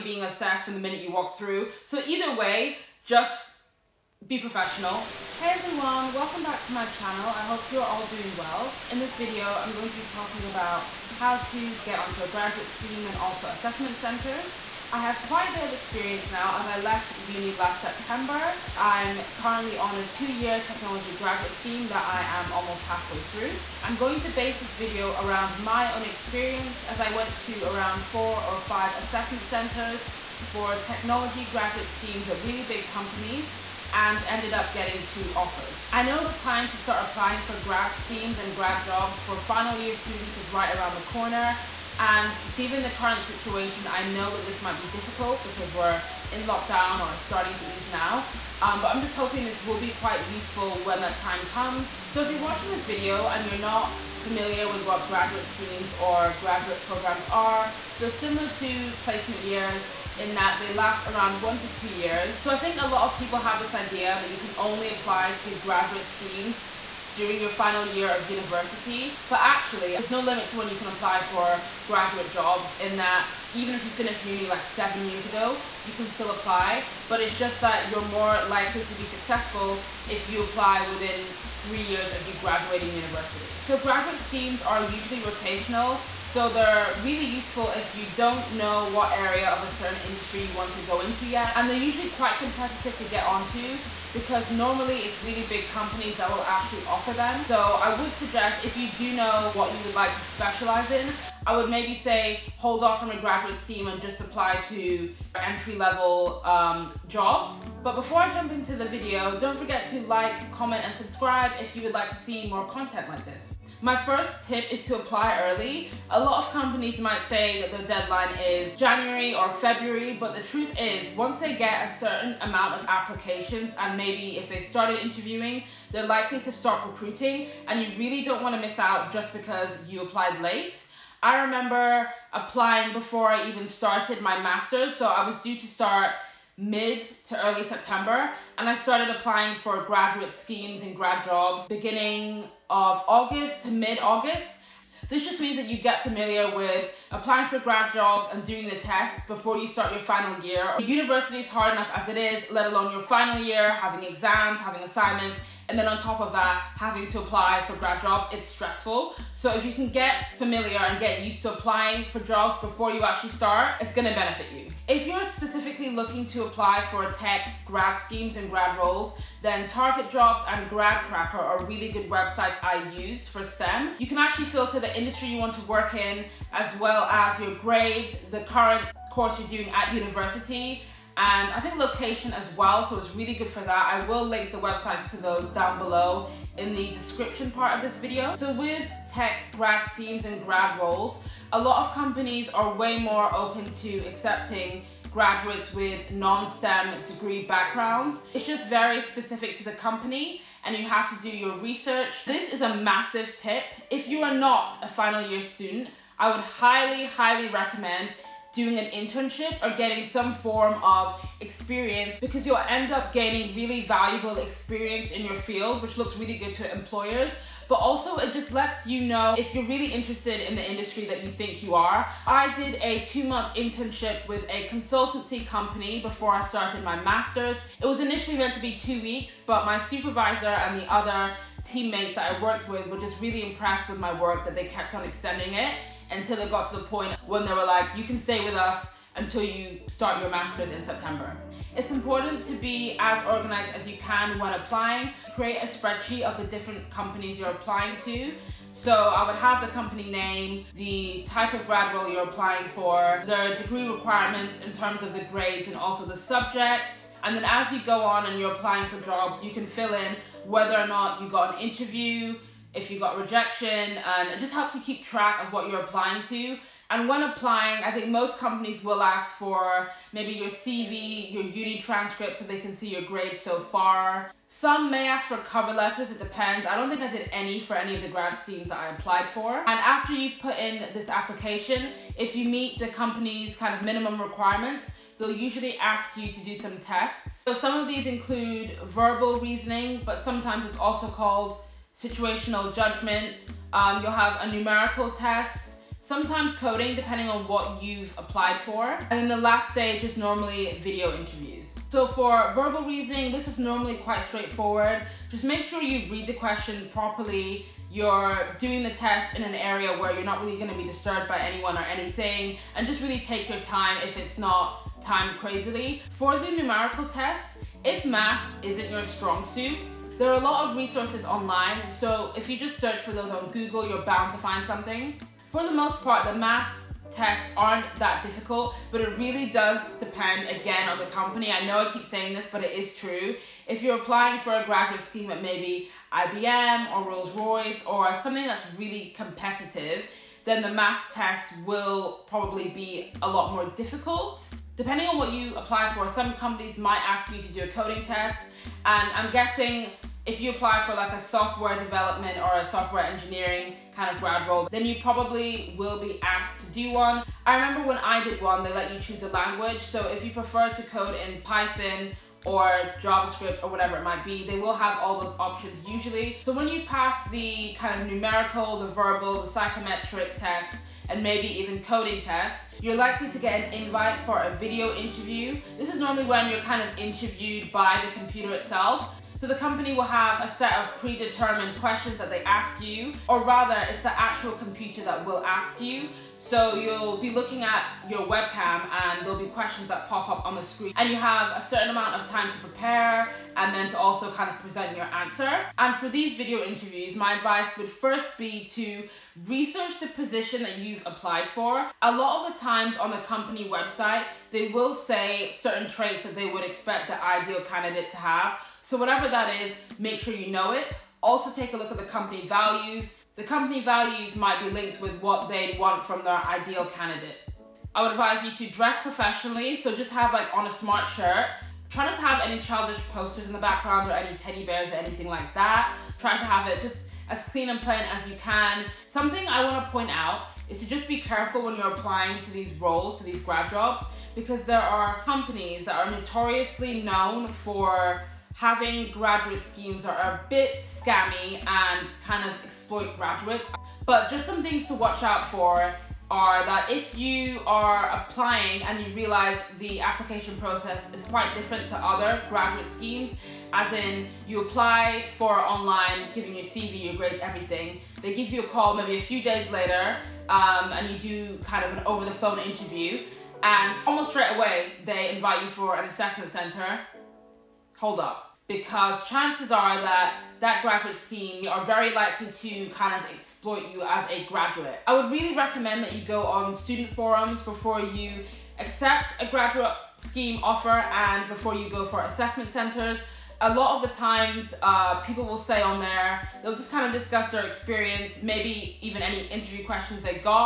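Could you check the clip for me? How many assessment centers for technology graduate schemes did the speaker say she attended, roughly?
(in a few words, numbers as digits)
4 or 5.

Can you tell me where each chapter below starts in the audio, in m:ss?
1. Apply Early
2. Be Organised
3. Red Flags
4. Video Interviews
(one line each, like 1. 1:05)
1. 1:53
2. 4:01
3. 7:08
4. 6:12.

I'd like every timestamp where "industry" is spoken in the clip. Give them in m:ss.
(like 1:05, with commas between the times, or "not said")
1:30, 2:54, 3:40.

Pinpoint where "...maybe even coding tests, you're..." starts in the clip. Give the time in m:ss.
6:11.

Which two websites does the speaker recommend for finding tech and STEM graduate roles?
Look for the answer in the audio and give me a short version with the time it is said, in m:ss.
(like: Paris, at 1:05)
Target Jobs and GradCracker, at 2:49.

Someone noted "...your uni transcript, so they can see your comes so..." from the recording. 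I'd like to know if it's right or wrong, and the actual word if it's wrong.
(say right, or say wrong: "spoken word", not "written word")
wrong: "grades", not "comes".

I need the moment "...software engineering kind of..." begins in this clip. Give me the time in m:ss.
5:52.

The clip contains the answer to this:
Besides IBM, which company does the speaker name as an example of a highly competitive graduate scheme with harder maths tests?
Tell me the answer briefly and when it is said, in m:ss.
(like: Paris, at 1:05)
Rolls Royce, at 5:37.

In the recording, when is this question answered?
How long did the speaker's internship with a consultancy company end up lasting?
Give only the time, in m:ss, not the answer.
3:43.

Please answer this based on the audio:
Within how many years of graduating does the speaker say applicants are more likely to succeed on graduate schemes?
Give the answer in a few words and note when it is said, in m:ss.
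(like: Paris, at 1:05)
3, at 1:21.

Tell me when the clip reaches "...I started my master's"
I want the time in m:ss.
3:46.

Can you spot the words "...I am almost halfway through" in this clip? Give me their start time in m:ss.
0:22.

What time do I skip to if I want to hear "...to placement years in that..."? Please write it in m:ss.
0:58.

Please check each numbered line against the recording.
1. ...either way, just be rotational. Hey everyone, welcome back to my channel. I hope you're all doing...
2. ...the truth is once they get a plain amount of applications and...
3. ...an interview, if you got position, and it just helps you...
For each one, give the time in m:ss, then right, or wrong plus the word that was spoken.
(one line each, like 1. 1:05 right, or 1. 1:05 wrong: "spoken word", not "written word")
1. 0:02 wrong: "professional", not "rotational"
2. 2:00 wrong: "certain", not "plain"
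3. 4:21 wrong: "rejection", not "position".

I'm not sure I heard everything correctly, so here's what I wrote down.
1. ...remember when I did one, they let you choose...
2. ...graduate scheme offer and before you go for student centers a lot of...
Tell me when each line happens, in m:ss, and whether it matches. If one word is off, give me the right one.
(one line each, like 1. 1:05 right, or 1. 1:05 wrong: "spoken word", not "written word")
1. 5:57 right
2. 7:59 wrong: "assessment", not "student".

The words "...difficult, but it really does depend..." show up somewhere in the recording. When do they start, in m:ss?
5:28.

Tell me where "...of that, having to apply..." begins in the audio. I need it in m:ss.
2:36.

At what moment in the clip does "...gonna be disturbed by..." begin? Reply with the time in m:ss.
5:10.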